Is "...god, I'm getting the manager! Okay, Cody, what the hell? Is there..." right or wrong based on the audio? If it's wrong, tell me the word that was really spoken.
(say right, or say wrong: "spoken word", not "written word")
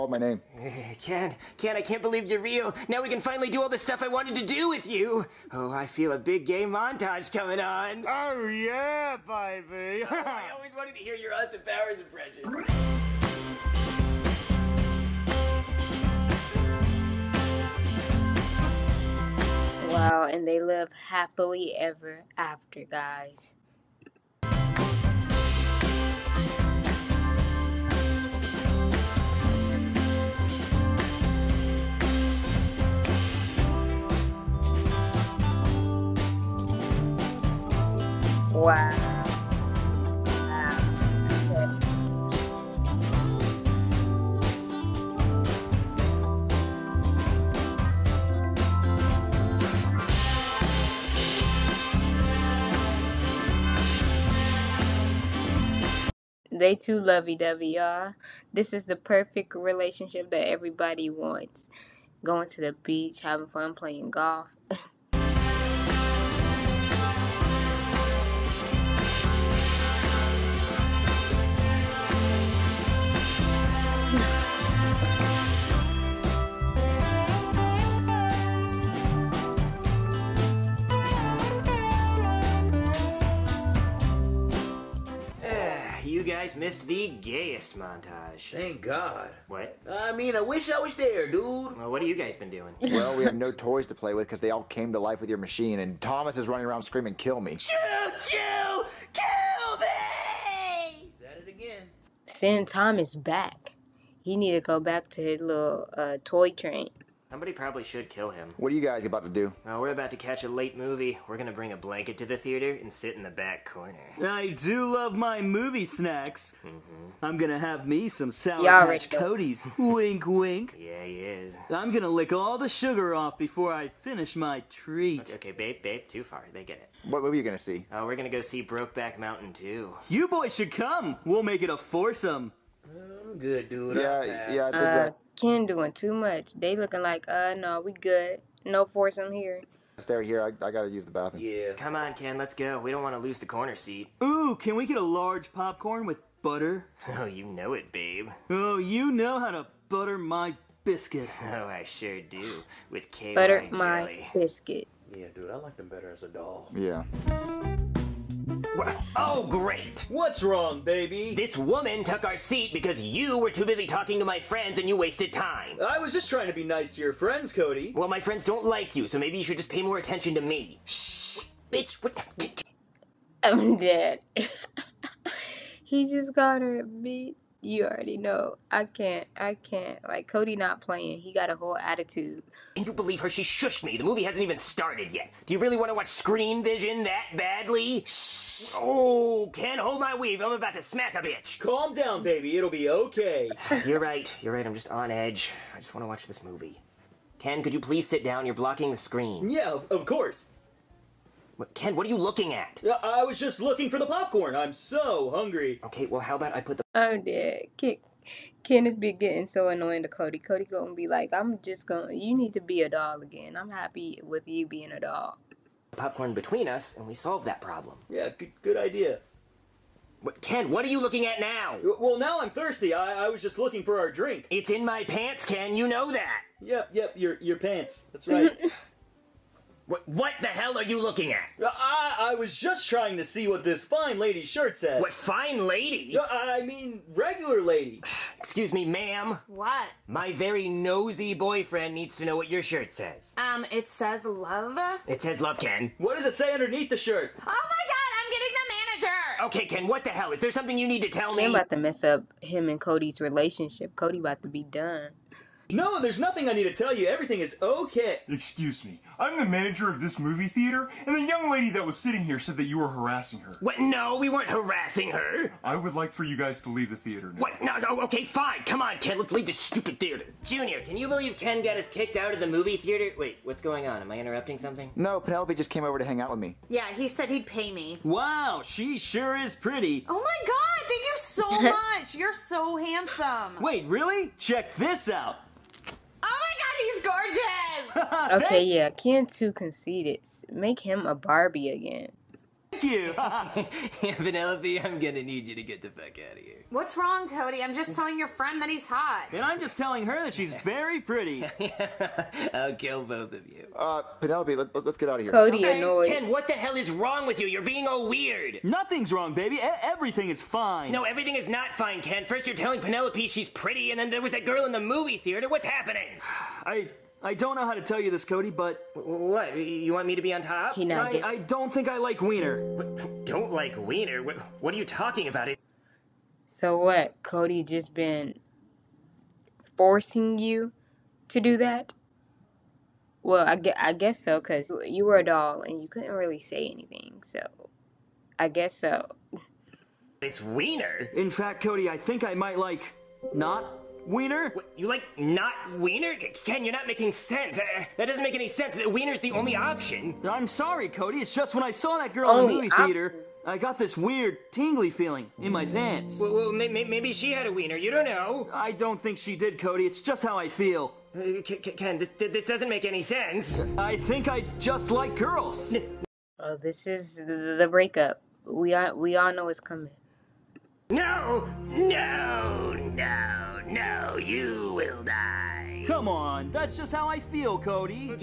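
wrong: "Ken", not "Cody".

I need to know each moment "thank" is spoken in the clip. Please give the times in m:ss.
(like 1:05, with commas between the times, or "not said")
1:28, 4:40, 4:52.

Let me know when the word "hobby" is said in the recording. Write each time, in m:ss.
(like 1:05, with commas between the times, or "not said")
not said.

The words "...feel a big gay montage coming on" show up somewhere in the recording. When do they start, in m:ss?
0:05.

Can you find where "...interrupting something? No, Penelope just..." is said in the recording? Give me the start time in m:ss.
4:34.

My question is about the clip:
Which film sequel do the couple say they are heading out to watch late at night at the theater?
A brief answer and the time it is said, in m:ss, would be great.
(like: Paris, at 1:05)
Brokeback Mountain 2, at 2:08.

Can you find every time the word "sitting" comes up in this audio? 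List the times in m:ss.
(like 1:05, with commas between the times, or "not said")
4:21.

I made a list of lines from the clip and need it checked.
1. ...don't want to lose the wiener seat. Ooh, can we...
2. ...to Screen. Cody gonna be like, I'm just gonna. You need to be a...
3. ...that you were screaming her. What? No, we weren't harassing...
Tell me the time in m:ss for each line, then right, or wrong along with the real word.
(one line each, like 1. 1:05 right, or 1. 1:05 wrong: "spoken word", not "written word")
1. 2:22 wrong: "corner", not "wiener"
2. 3:30 wrong: "Cody", not "Screen"
3. 4:22 wrong: "harassing", not "screaming".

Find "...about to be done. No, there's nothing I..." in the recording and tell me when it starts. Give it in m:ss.
4:14.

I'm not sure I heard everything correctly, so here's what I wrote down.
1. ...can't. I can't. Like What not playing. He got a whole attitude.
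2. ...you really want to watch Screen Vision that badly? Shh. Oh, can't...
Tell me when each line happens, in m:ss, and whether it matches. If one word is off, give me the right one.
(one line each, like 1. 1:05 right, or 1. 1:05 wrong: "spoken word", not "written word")
1. 2:58 wrong: "Cody", not "What"
2. 3:05 right.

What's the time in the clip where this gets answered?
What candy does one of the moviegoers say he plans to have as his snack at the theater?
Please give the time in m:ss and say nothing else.
1:58.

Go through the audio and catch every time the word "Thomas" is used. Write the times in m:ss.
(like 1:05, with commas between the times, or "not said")
1:35, 1:42.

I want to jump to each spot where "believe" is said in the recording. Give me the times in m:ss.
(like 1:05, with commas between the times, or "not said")
0:02, 3:02, 4:31.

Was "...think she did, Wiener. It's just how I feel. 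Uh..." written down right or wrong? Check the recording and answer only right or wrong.
wrong.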